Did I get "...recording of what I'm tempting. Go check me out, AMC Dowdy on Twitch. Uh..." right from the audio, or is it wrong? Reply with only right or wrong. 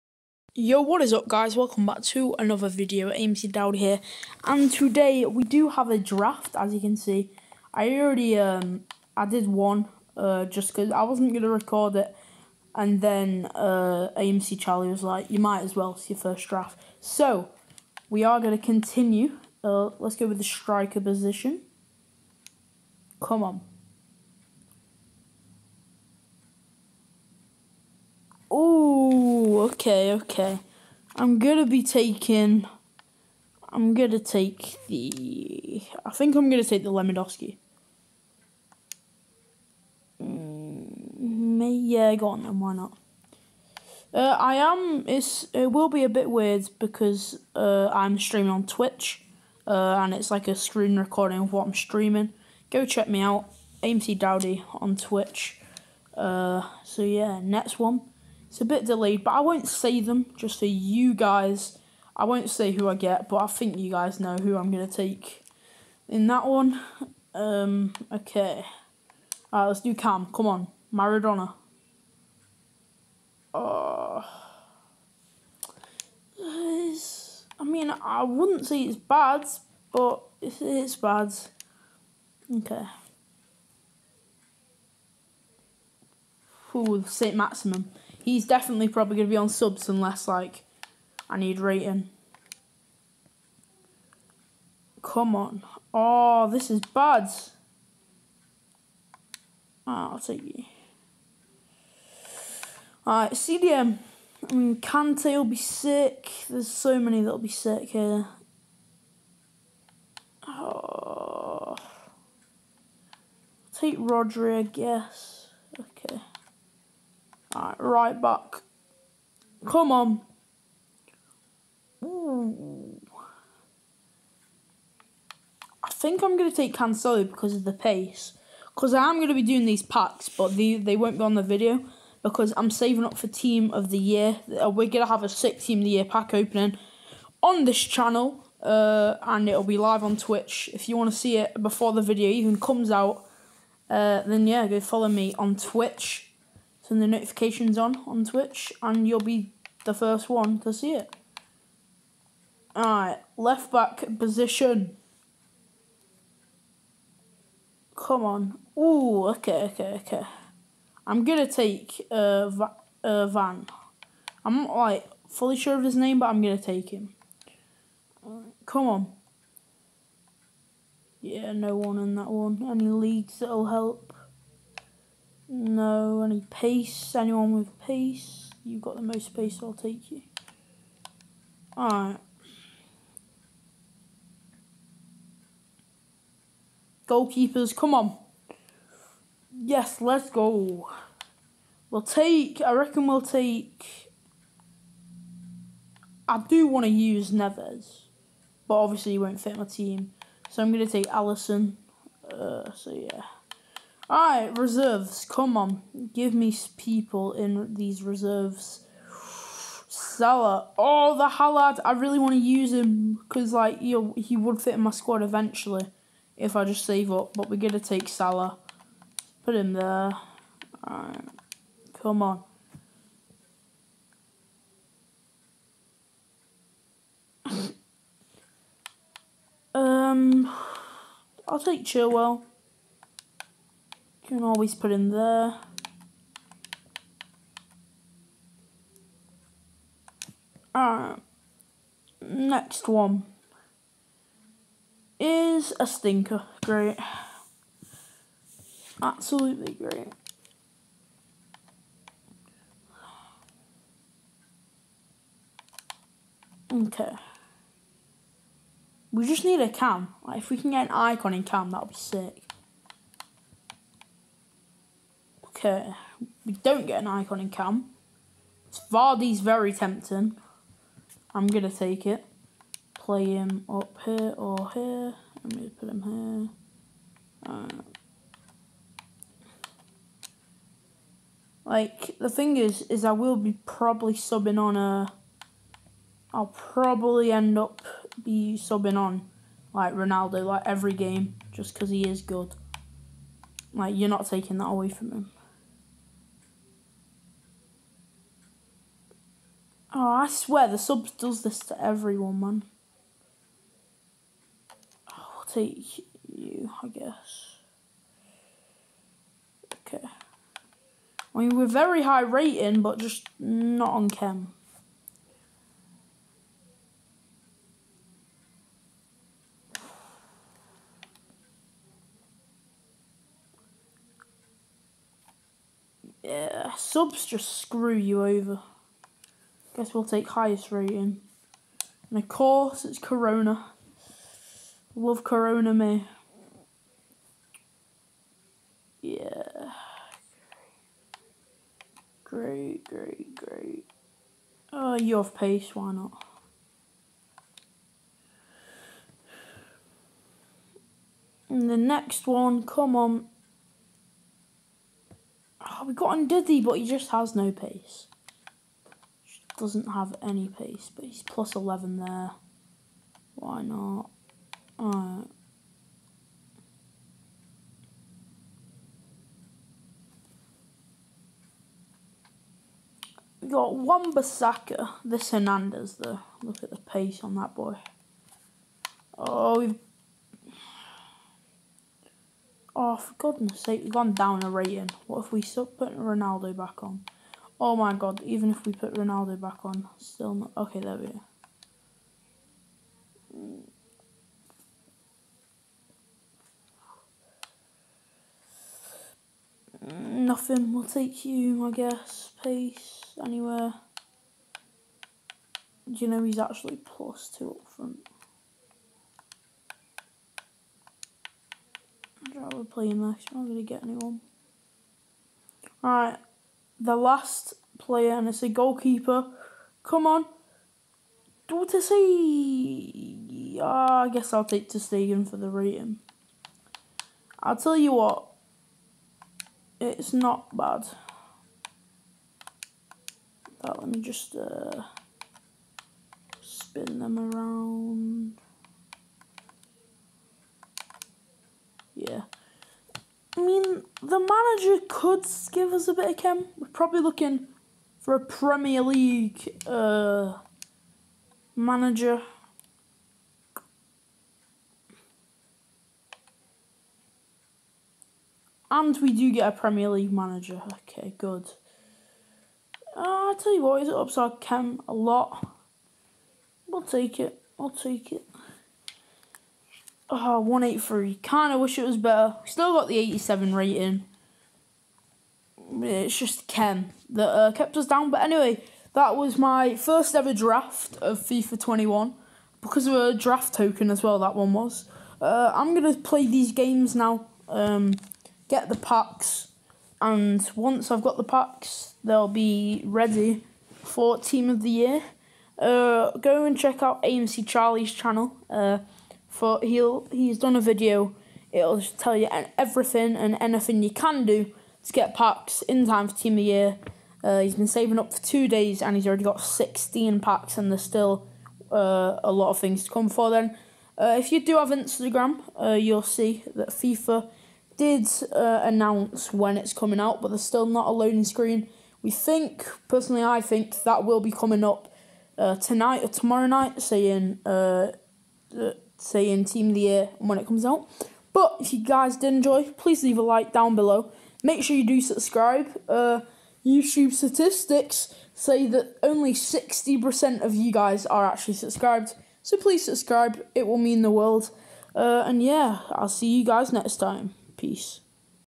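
wrong.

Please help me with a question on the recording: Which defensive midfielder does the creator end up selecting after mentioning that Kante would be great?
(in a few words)
Rodri.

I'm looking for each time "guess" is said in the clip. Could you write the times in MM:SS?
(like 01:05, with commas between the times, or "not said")
01:54, 05:06, 05:29, 06:41, 07:04.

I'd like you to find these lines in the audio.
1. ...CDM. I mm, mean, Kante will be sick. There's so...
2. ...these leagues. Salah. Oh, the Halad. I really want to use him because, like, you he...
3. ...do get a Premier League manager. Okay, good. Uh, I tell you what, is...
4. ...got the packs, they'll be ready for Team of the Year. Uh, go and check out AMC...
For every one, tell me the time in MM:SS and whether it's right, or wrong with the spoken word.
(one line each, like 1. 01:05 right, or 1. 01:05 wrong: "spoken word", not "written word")
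1. 01:43 right
2. 03:27 wrong: "reserves", not "leagues"
3. 07:39 right
4. 08:11 right.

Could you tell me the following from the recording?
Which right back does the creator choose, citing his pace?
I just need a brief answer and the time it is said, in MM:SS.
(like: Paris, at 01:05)
Cancelo, at 02:06.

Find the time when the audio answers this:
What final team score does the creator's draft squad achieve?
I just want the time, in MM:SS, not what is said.
07:50.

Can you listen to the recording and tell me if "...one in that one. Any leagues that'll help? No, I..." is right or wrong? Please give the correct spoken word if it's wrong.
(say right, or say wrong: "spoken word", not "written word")
right.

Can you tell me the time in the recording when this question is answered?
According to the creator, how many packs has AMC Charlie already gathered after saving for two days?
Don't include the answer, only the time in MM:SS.
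08:29.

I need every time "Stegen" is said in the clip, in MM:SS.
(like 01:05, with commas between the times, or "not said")
07:04.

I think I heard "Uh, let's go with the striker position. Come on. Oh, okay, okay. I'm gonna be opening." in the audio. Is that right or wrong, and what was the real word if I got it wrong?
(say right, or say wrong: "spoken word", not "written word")
wrong: "taking", not "opening".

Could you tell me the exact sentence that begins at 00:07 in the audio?
I already, um, I did one, uh, just because I wasn't going to record it.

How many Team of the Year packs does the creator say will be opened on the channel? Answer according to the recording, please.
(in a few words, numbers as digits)
6.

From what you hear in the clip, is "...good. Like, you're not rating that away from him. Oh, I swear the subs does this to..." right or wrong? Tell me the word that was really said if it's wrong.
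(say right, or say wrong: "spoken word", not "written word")
wrong: "taking", not "rating".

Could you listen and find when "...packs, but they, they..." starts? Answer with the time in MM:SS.
02:09.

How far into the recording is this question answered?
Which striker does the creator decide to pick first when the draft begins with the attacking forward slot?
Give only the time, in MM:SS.
00:36.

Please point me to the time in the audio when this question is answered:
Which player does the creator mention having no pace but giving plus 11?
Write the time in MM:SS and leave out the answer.
05:56.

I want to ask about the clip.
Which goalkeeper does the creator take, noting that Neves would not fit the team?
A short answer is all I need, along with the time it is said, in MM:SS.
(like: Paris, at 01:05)
Alisson, at 03:21.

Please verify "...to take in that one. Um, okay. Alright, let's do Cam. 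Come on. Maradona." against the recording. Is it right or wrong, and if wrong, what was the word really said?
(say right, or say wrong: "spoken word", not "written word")
right.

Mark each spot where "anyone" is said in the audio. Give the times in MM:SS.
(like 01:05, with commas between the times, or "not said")
02:57, 06:53.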